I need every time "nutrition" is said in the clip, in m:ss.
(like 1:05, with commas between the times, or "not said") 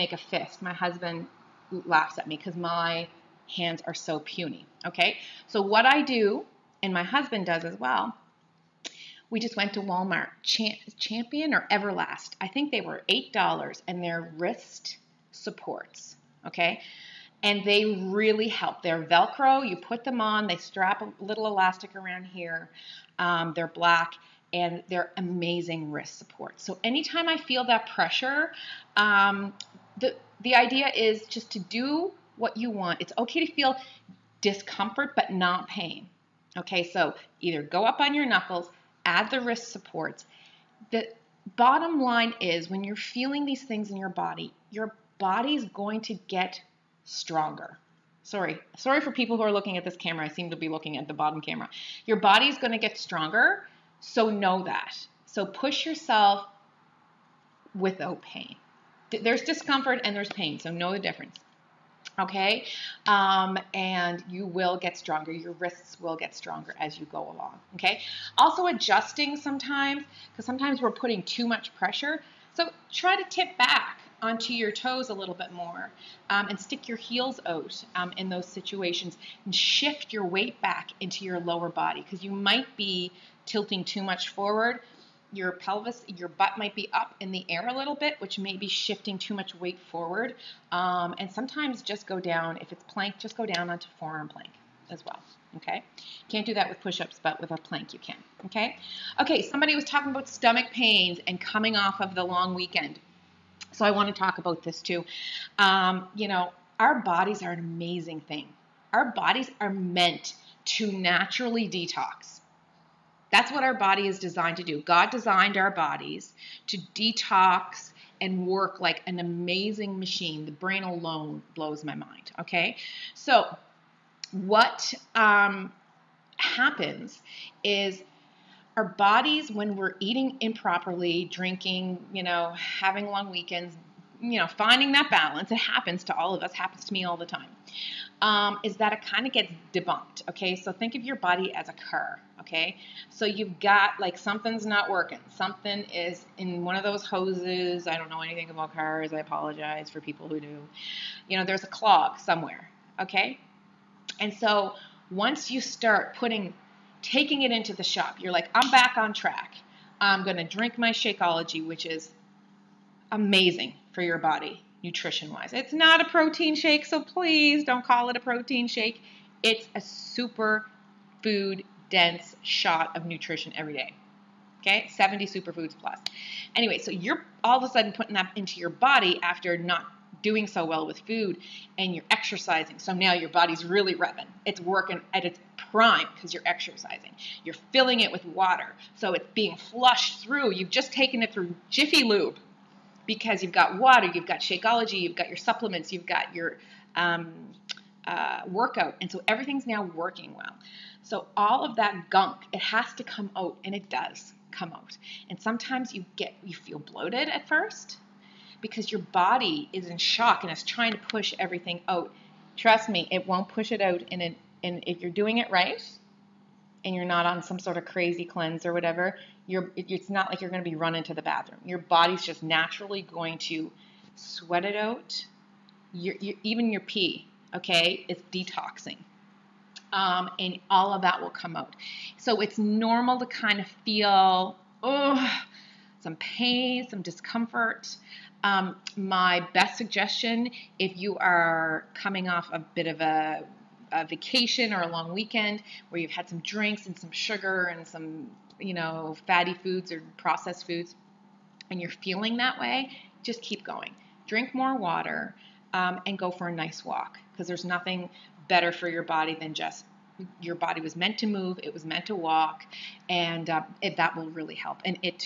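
2:44, 2:53.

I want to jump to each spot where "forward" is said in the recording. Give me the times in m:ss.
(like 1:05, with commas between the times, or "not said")
1:24, 1:29.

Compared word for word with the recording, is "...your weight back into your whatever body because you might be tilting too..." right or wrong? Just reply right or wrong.
wrong.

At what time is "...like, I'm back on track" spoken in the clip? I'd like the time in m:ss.
2:38.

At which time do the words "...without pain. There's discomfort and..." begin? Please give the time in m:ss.
0:57.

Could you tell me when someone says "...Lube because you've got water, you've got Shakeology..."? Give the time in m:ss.
3:12.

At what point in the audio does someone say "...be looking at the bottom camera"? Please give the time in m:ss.
0:50.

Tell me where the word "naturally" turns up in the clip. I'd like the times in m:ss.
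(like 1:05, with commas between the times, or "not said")
1:50, 3:42.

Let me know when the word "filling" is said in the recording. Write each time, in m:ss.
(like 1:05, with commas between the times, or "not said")
3:07.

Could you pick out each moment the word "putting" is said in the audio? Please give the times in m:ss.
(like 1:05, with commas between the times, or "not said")
1:10, 2:36, 2:57.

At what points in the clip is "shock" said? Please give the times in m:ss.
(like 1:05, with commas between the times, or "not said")
3:29.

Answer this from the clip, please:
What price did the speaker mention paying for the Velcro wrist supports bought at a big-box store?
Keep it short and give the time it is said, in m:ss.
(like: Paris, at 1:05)
$8, at 0:13.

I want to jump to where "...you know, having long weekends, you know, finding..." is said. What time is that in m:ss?
2:12.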